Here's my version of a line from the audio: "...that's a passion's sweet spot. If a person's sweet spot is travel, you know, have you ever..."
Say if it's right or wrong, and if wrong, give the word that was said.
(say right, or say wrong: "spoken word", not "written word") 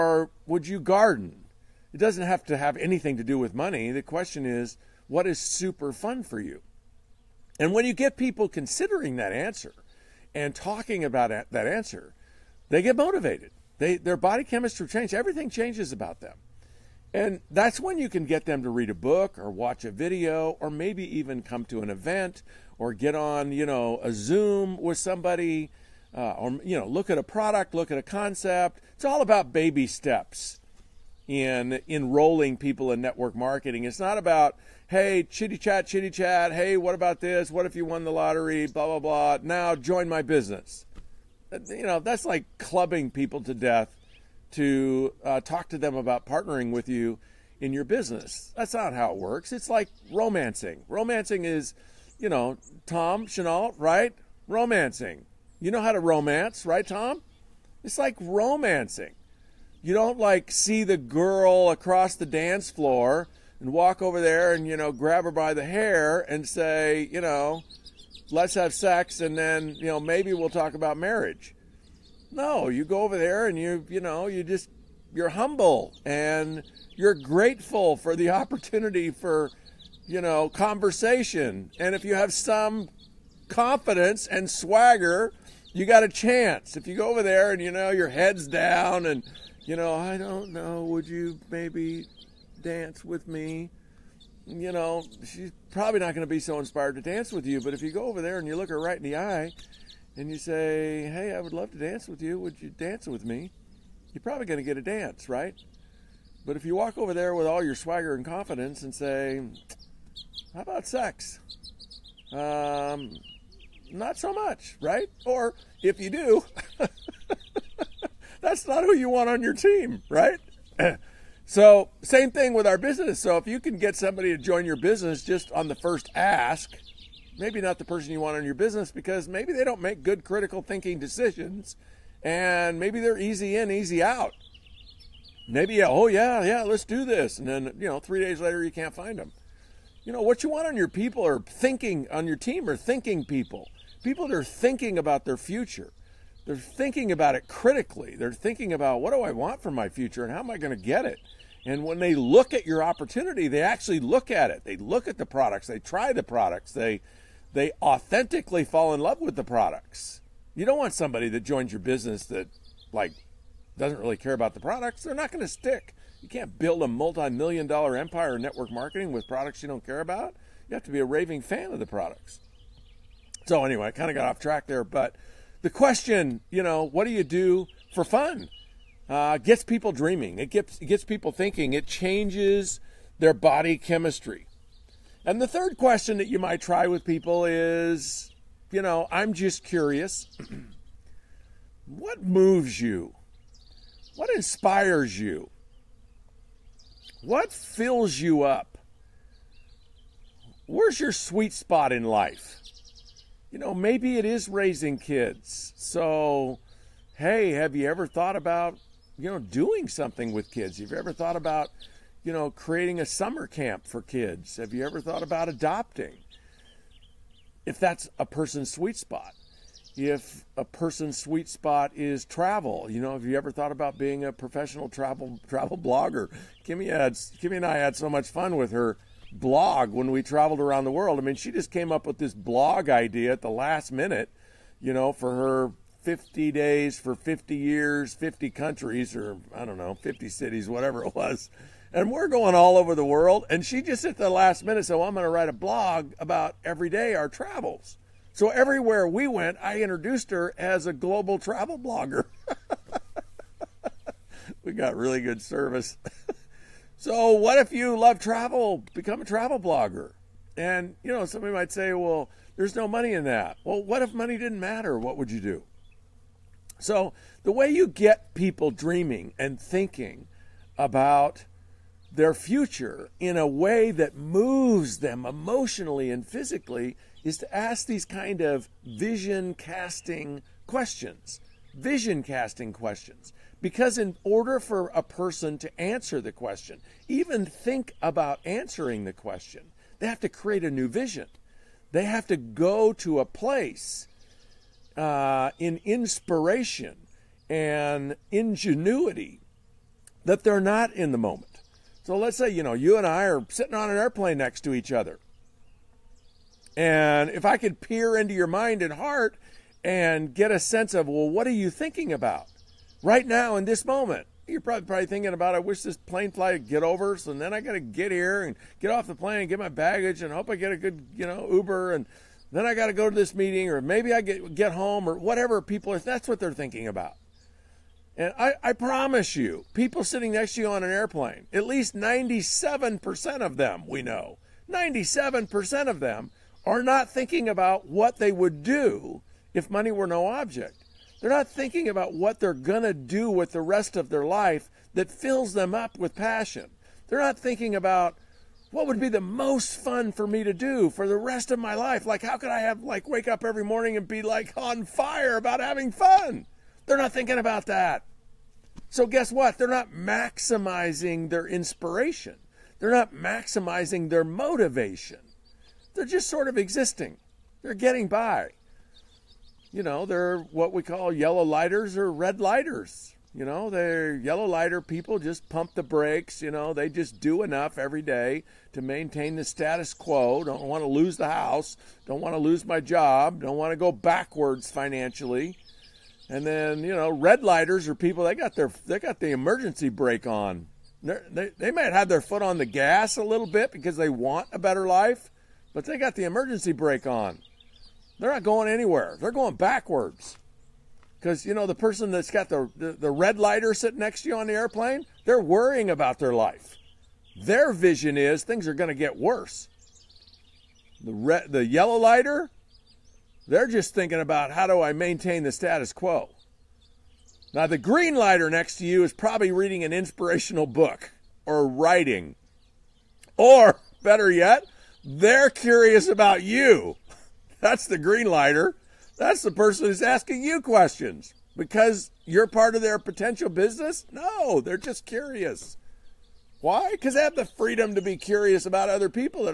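wrong: "person", not "passion".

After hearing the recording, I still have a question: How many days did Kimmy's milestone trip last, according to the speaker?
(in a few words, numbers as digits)
50.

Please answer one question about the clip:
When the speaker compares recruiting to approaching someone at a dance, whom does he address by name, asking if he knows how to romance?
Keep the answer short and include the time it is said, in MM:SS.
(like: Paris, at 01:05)
Tom Chenault, at 00:52.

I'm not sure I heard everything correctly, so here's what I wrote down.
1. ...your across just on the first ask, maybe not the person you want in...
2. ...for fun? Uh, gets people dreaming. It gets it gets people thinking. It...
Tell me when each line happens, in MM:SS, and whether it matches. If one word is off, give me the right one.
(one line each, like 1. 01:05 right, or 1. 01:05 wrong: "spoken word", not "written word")
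1. 02:04 wrong: "business", not "across"
2. 02:57 right.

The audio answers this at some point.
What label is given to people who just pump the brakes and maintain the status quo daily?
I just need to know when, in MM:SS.
06:11.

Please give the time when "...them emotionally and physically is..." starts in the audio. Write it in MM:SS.
04:34.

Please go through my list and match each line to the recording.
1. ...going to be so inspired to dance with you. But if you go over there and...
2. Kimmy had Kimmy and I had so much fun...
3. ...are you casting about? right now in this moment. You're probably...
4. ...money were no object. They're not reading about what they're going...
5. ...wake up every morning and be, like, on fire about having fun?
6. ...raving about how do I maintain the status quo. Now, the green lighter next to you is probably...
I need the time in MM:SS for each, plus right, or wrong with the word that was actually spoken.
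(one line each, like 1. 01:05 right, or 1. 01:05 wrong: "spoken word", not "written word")
1. 01:36 right
2. 03:46 right
3. 05:11 wrong: "thinking", not "casting"
4. 05:39 wrong: "thinking", not "reading"
5. 05:53 right
6. 06:53 wrong: "thinking", not "raving".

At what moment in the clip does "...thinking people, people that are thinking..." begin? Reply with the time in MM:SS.
02:22.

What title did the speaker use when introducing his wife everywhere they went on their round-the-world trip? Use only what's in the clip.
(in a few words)
global travel blogger.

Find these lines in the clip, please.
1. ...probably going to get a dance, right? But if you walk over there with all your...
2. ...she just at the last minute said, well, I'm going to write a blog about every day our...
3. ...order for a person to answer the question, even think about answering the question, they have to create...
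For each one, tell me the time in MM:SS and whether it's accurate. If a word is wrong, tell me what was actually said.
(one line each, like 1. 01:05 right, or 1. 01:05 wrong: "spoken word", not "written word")
1. 01:44 right
2. 04:03 right
3. 04:44 right.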